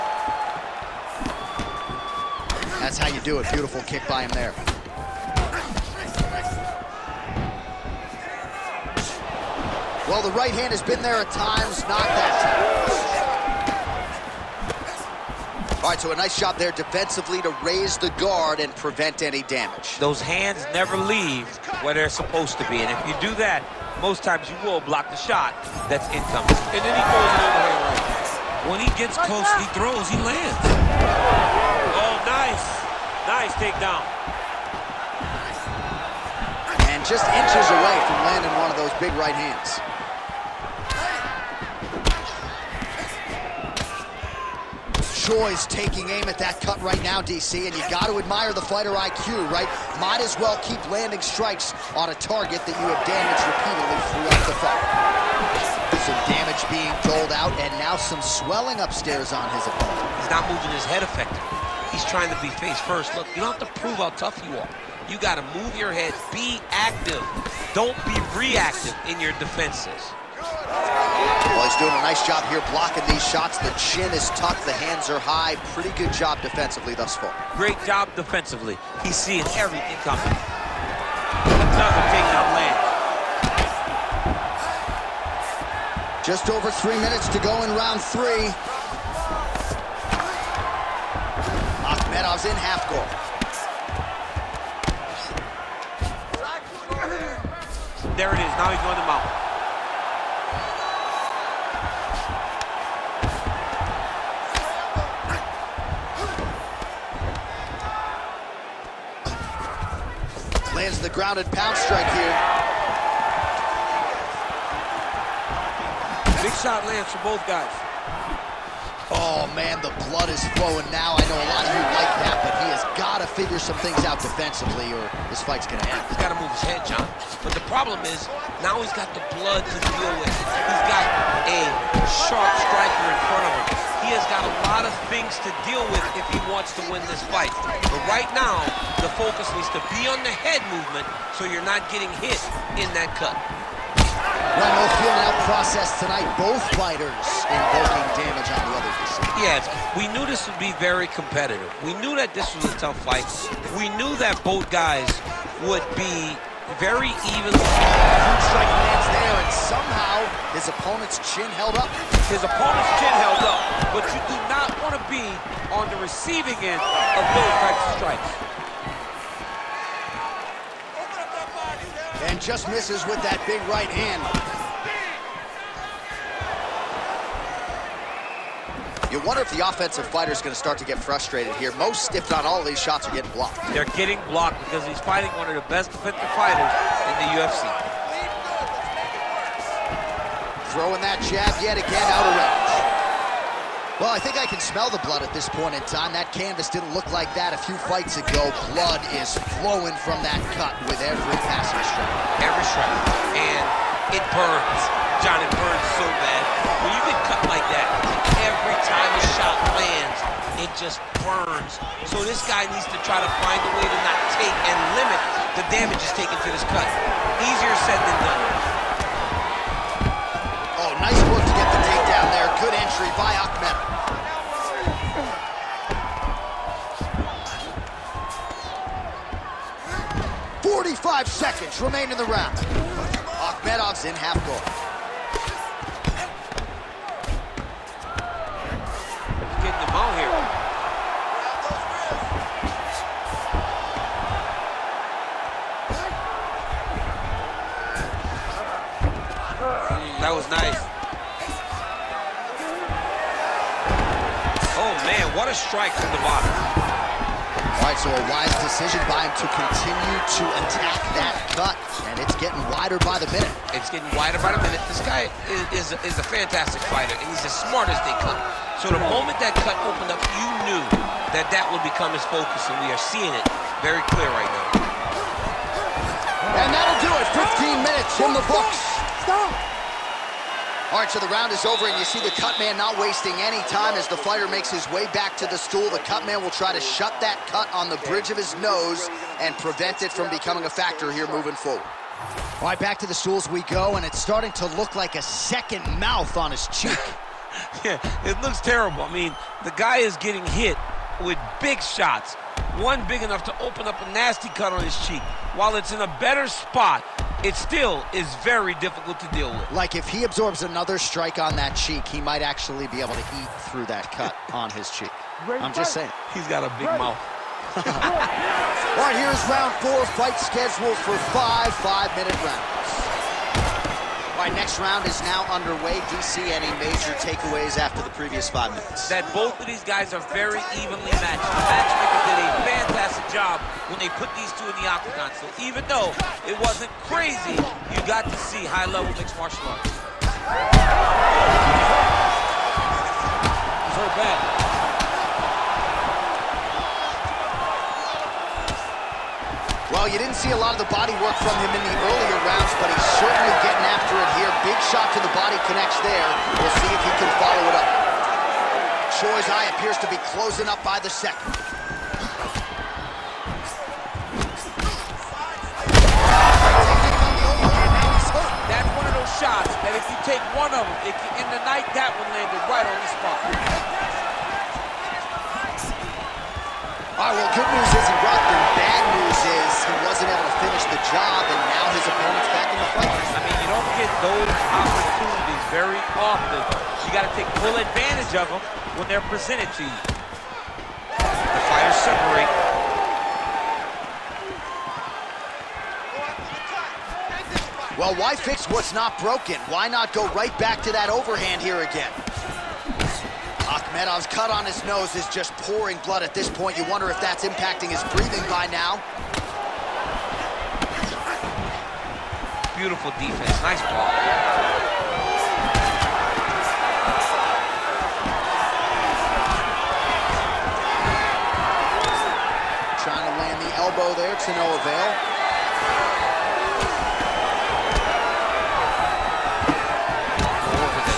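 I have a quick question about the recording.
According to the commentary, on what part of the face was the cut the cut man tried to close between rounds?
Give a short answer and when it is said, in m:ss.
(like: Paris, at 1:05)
Bridge of his nose, at 4:48.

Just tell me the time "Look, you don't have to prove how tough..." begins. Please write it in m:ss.
1:03.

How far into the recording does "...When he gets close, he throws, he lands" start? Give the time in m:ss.
0:28.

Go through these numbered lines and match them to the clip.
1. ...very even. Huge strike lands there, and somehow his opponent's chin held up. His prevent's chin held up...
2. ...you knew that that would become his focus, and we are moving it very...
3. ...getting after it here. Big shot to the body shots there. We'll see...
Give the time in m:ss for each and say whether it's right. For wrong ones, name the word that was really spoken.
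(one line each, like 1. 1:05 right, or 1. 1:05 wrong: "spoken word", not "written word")
1. 2:36 wrong: "opponent", not "prevent"
2. 4:30 wrong: "seeing", not "moving"
3. 5:53 wrong: "connects", not "shots".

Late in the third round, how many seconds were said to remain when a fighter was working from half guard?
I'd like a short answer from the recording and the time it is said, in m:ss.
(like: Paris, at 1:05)
45, at 3:50.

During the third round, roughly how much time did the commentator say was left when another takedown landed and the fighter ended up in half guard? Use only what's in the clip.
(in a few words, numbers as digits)
Just over 3 minutes.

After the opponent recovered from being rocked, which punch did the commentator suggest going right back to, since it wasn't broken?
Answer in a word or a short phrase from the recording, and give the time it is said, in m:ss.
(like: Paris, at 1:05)
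Overhand, at 6:41.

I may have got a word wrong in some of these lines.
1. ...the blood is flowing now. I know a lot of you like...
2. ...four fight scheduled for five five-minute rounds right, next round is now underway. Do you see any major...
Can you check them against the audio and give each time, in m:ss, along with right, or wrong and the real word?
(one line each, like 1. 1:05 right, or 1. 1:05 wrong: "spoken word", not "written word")
1. 1:59 right
2. 5:19 right.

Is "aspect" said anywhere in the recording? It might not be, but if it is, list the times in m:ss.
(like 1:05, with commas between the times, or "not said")
not said.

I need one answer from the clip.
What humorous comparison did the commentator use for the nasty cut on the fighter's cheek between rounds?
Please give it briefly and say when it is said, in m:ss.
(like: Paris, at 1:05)
A second mouth, at 4:55.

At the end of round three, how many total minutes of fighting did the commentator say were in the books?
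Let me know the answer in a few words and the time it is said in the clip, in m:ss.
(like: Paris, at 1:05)
15, at 4:37.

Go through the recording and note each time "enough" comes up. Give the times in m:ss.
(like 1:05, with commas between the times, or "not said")
5:03.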